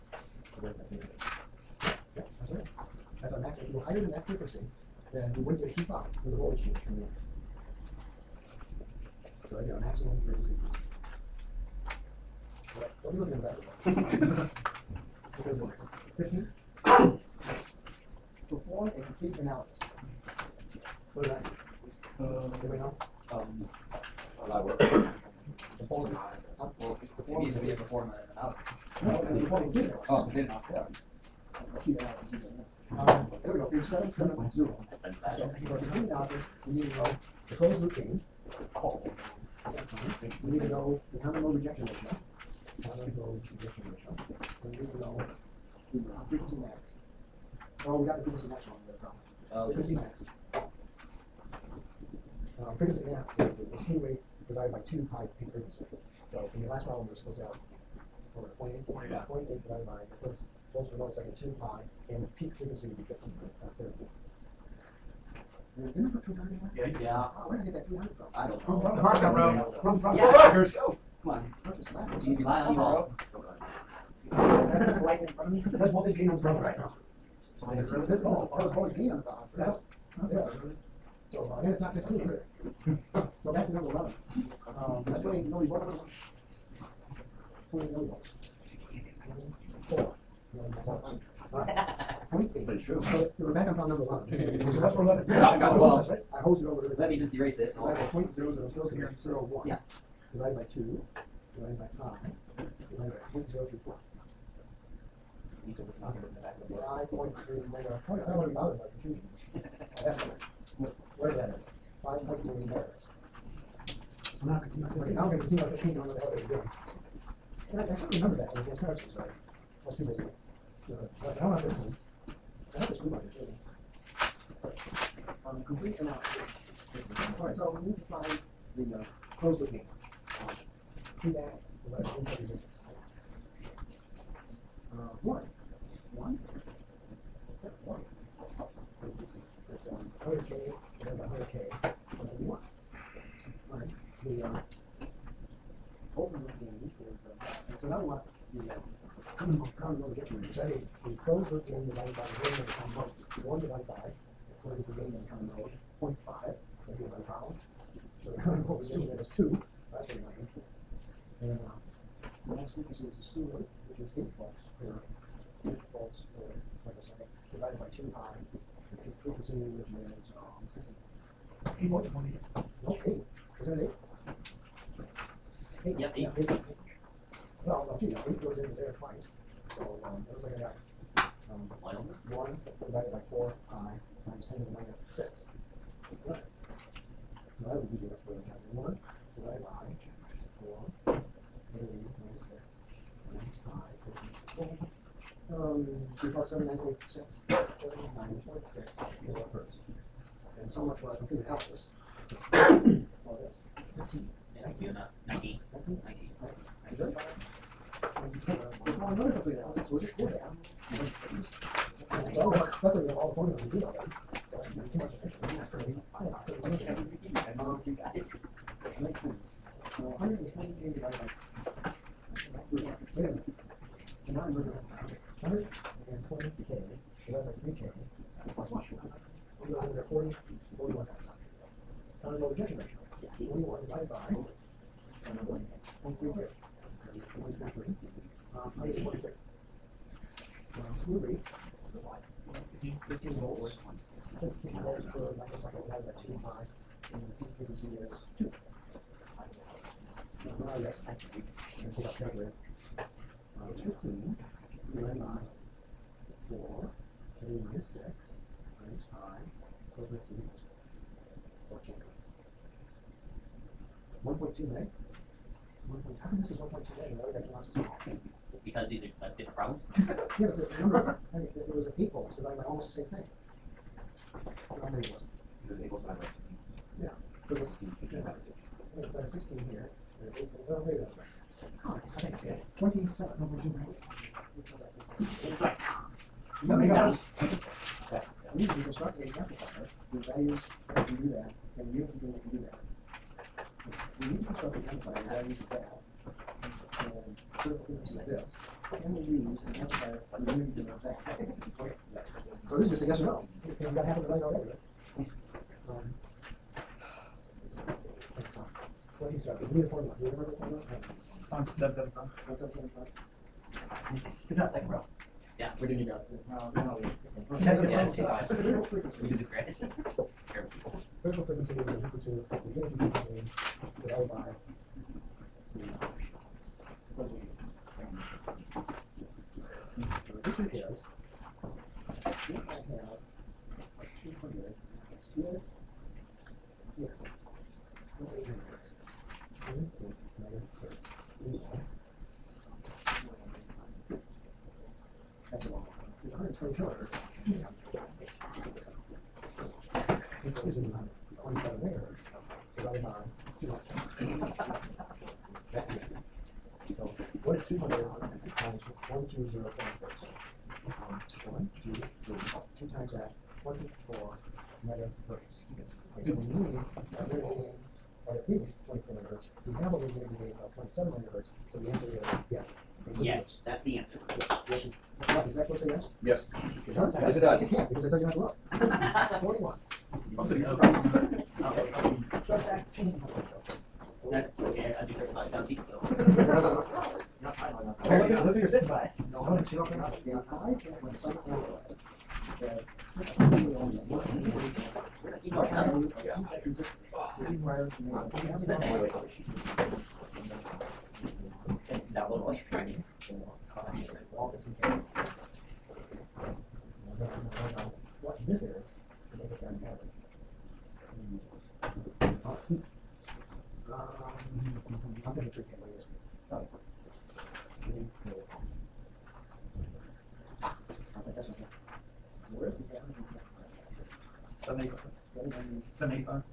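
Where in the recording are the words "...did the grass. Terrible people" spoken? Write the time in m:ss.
5:19.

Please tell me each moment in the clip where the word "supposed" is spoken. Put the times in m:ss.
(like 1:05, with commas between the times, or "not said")
0:57.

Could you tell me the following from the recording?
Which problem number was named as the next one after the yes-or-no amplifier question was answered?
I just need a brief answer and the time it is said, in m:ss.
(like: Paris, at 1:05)
41, at 6:18.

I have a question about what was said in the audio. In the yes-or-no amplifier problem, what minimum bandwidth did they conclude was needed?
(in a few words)
24 megahertz.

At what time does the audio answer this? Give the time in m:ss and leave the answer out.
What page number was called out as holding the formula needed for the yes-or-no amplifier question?
5:11.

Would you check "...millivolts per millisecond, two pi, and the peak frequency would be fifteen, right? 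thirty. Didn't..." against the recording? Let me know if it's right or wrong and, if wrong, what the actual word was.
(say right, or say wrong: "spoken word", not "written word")
wrong: "volts", not "millivolts".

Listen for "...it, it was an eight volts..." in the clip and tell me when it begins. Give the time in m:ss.
4:31.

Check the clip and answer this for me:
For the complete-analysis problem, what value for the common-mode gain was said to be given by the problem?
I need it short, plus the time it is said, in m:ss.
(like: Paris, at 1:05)
0.5, at 2:36.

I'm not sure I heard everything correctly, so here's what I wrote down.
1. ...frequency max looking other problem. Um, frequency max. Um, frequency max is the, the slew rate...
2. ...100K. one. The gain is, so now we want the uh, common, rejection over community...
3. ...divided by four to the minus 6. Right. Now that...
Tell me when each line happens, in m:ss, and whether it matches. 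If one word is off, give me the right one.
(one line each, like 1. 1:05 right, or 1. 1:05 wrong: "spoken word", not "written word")
1. 0:48 wrong: "wrong", not "looking"
2. 2:20 wrong: "common", not "rejection"
3. 3:02 right.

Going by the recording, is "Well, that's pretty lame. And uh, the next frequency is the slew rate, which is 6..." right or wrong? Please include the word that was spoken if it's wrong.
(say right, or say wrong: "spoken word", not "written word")
wrong: "8", not "6".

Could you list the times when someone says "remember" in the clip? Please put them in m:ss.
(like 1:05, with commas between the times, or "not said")
1:58, 5:10.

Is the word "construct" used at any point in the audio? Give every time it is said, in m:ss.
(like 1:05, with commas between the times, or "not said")
4:48, 4:54.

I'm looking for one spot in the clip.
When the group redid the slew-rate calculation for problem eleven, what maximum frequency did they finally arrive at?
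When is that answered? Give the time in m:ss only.
1:52.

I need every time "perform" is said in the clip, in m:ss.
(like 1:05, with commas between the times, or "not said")
0:18, 0:27.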